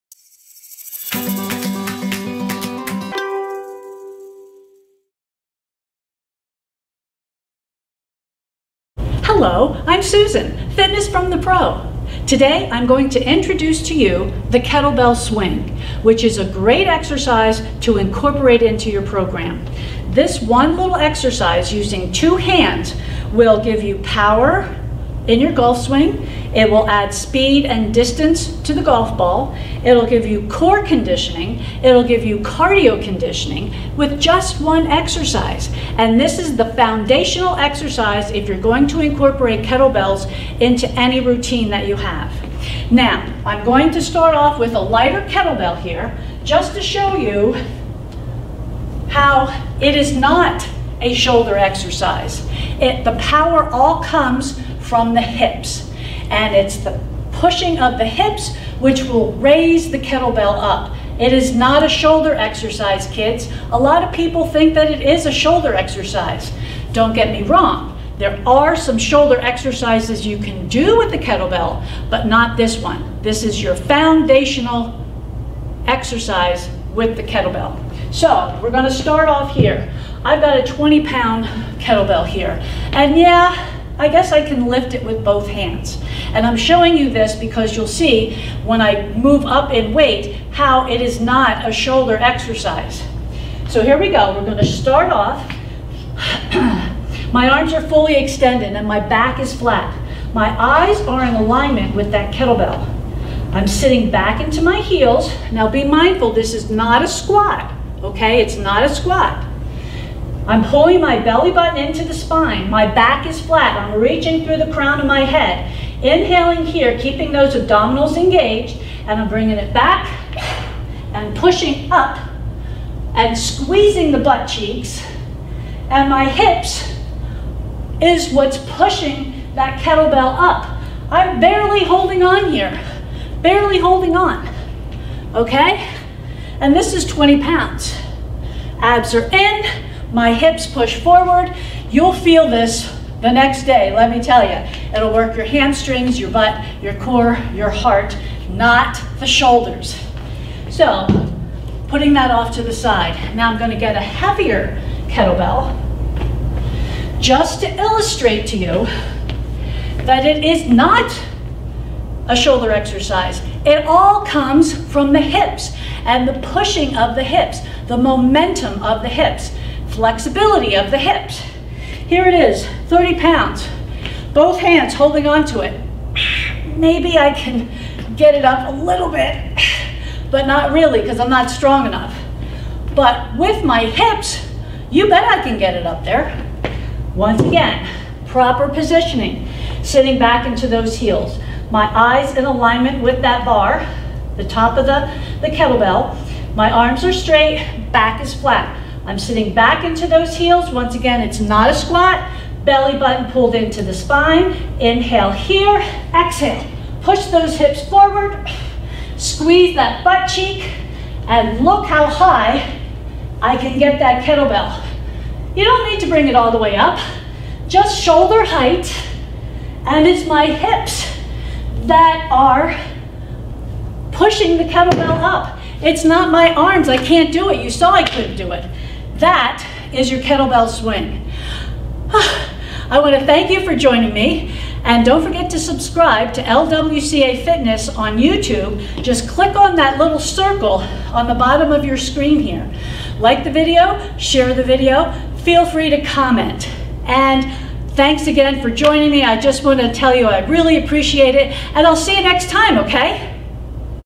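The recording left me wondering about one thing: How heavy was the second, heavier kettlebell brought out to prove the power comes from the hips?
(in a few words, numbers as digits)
30 pounds.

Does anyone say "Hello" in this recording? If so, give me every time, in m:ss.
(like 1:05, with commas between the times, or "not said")
0:09.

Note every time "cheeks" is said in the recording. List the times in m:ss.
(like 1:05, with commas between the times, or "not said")
2:04, 3:30.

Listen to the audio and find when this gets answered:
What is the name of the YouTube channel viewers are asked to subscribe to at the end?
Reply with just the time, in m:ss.
3:56.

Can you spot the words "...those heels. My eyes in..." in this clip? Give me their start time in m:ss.
3:10.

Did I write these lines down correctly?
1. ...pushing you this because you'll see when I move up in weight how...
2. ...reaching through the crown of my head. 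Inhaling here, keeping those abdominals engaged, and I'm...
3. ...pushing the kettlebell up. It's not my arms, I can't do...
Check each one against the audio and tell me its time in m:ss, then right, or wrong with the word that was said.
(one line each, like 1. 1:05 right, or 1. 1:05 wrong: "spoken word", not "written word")
1. 1:26 wrong: "showing", not "pushing"
2. 1:53 right
3. 3:44 right.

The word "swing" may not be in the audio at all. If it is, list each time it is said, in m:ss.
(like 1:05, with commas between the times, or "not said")
0:15, 0:25, 3:50.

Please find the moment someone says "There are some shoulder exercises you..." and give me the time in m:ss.
1:08.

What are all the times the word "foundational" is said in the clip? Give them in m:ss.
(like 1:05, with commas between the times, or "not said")
0:36, 1:13.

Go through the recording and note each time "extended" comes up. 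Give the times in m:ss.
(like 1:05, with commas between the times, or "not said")
1:38.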